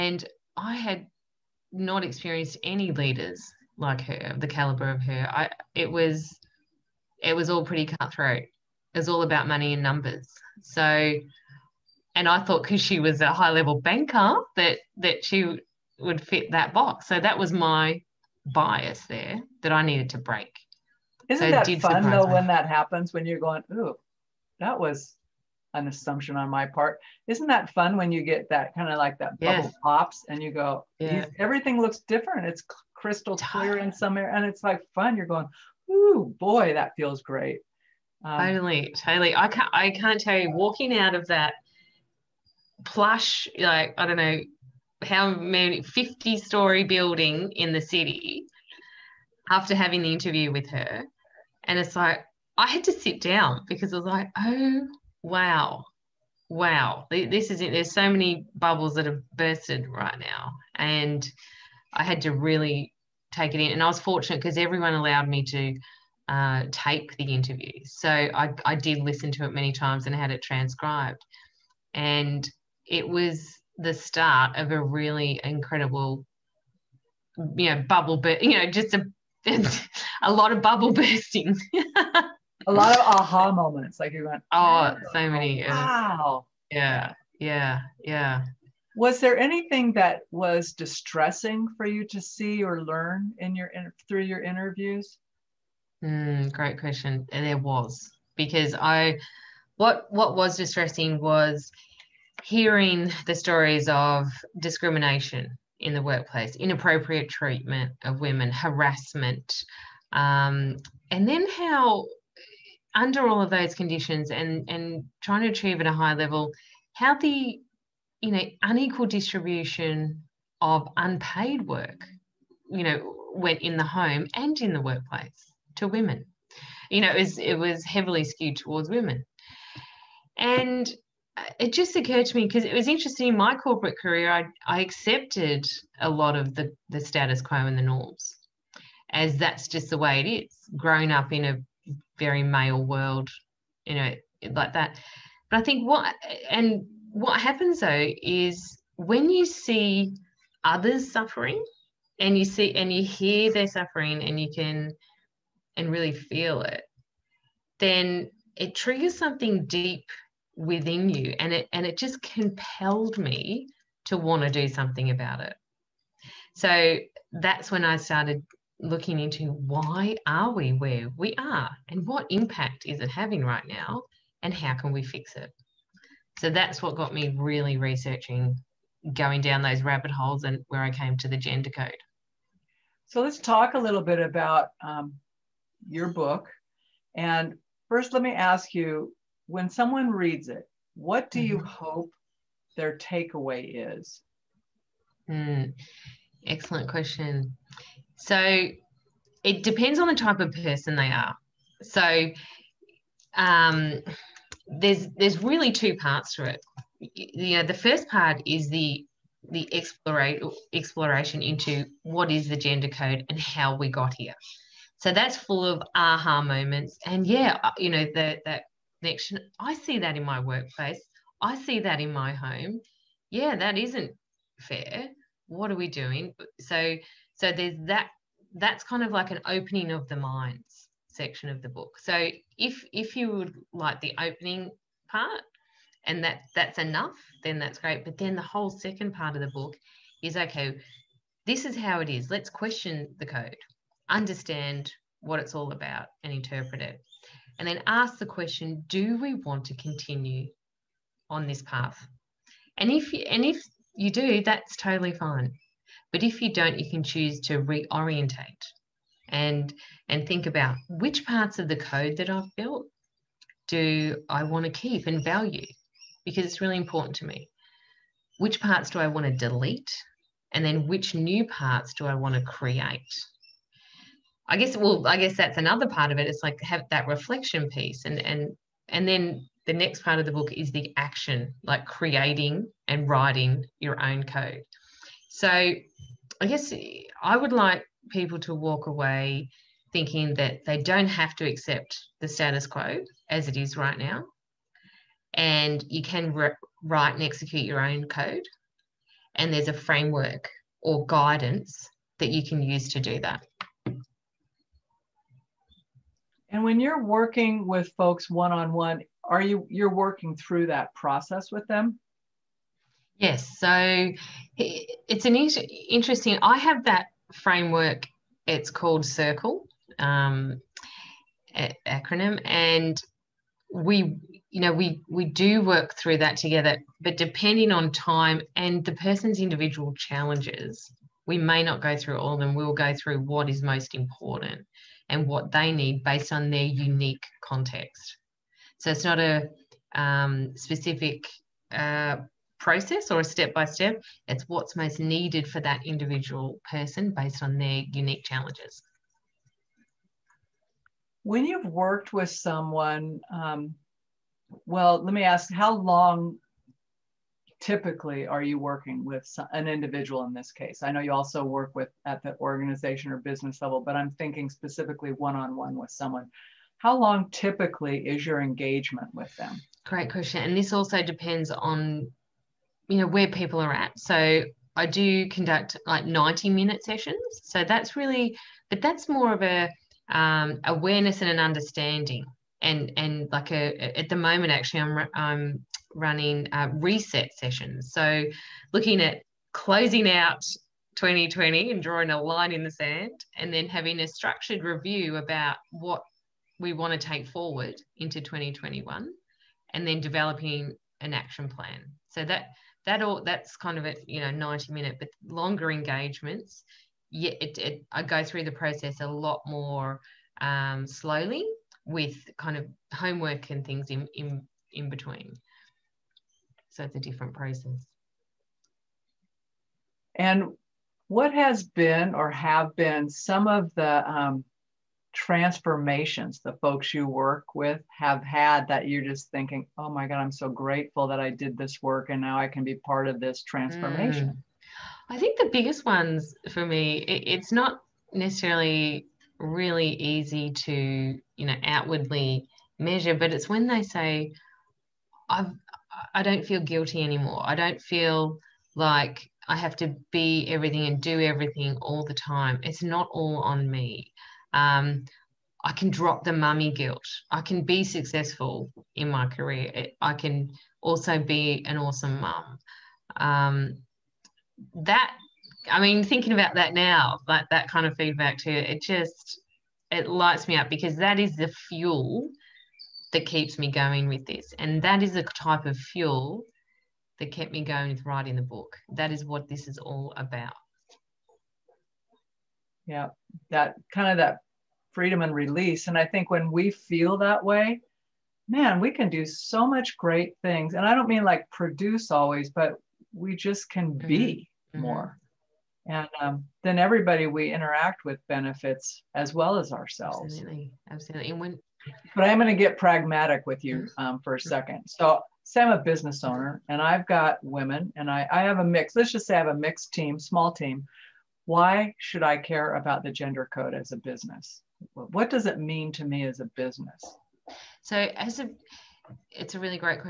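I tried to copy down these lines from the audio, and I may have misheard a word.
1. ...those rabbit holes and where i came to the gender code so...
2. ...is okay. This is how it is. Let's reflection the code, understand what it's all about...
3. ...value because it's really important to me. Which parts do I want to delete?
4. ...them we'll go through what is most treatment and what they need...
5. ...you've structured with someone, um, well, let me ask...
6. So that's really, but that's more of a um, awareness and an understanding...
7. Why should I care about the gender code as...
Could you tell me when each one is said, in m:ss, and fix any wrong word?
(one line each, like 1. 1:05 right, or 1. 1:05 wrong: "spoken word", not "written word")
1. 2:59 right
2. 4:00 wrong: "question", not "reflection"
3. 4:25 right
4. 5:32 wrong: "important", not "treatment"
5. 5:51 wrong: "worked", not "structured"
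6. 6:17 right
7. 8:31 right.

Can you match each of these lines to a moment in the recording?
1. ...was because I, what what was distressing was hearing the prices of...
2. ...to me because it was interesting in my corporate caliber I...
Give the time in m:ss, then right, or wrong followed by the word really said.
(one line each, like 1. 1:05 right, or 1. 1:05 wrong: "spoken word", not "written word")
1. 1:37 wrong: "stories", not "prices"
2. 2:12 wrong: "career", not "caliber".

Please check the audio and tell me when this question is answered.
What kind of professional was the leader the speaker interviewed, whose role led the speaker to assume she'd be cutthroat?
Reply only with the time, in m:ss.
0:13.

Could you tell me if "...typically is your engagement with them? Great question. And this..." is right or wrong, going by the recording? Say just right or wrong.
right.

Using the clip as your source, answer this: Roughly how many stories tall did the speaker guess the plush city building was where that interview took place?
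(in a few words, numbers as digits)
50.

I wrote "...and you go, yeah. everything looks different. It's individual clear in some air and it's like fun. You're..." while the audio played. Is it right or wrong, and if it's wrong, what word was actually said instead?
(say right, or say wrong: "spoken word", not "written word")
wrong: "crystal", not "individual".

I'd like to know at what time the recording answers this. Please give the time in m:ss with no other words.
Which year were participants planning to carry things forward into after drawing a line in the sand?
6:38.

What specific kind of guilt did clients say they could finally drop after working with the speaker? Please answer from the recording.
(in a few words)
Mummy guilt.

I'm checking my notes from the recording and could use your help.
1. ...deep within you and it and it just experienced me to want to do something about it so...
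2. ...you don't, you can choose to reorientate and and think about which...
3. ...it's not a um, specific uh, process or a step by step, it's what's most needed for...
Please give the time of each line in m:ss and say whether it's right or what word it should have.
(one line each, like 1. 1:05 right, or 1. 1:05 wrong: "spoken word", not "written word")
1. 2:39 wrong: "compelled", not "experienced"
2. 4:16 right
3. 5:38 right.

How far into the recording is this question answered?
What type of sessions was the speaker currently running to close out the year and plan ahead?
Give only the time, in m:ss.
6:26.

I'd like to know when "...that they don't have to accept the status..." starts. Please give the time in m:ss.
4:50.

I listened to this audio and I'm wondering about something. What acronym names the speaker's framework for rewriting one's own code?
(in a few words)
Circle.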